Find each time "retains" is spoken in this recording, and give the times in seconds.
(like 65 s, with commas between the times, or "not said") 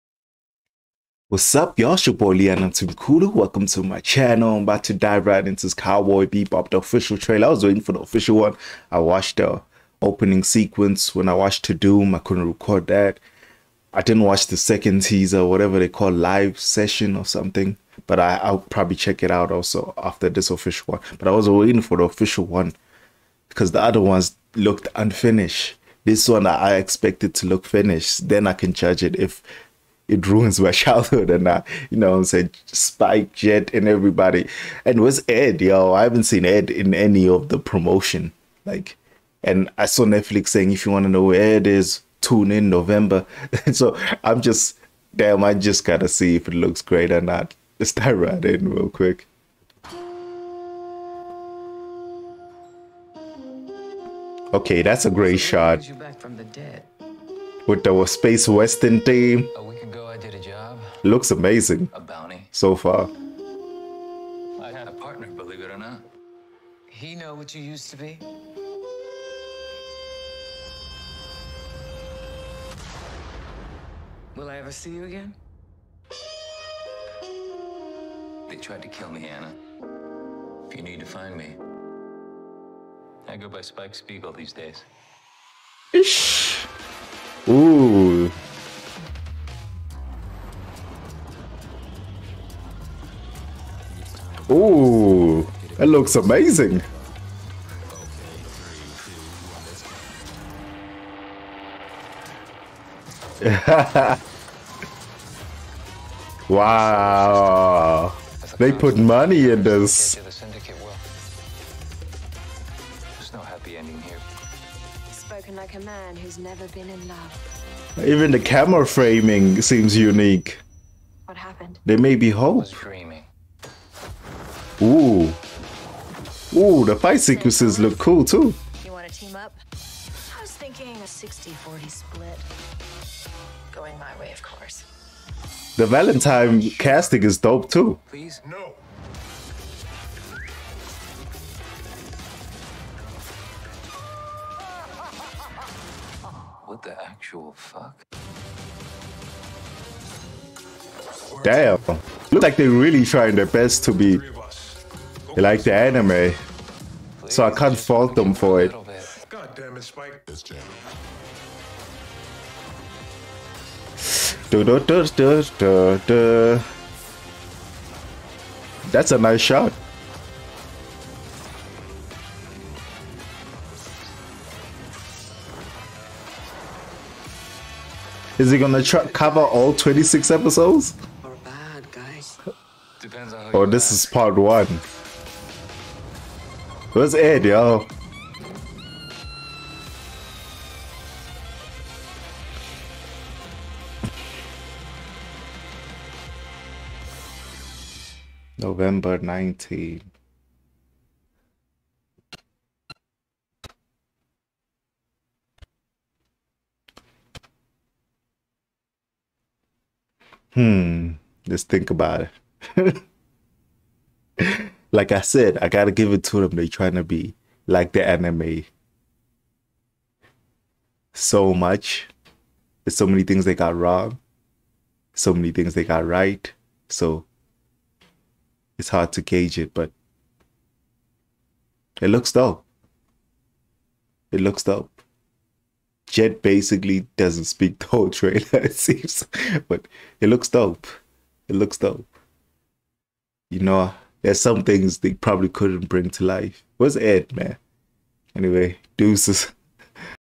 not said.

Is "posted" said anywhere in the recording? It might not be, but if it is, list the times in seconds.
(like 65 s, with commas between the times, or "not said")
not said.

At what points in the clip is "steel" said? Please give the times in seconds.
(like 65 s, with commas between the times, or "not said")
not said.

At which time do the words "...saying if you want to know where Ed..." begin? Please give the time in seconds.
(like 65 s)
40 s.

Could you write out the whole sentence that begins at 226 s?
So it's hard to gauge it, but it looks dope.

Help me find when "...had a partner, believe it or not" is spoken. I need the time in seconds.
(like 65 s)
64 s.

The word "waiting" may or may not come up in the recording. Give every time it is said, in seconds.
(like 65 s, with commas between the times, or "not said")
7 s, 21 s.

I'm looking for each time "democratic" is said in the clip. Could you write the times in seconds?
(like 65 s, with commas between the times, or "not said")
not said.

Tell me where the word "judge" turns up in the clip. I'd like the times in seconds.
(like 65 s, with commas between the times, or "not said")
28 s.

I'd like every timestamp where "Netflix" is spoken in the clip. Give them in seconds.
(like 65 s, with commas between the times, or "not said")
40 s.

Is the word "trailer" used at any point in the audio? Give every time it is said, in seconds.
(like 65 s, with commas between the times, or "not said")
7 s, 238 s.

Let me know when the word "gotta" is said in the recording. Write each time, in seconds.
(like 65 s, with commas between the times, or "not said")
45 s, 215 s.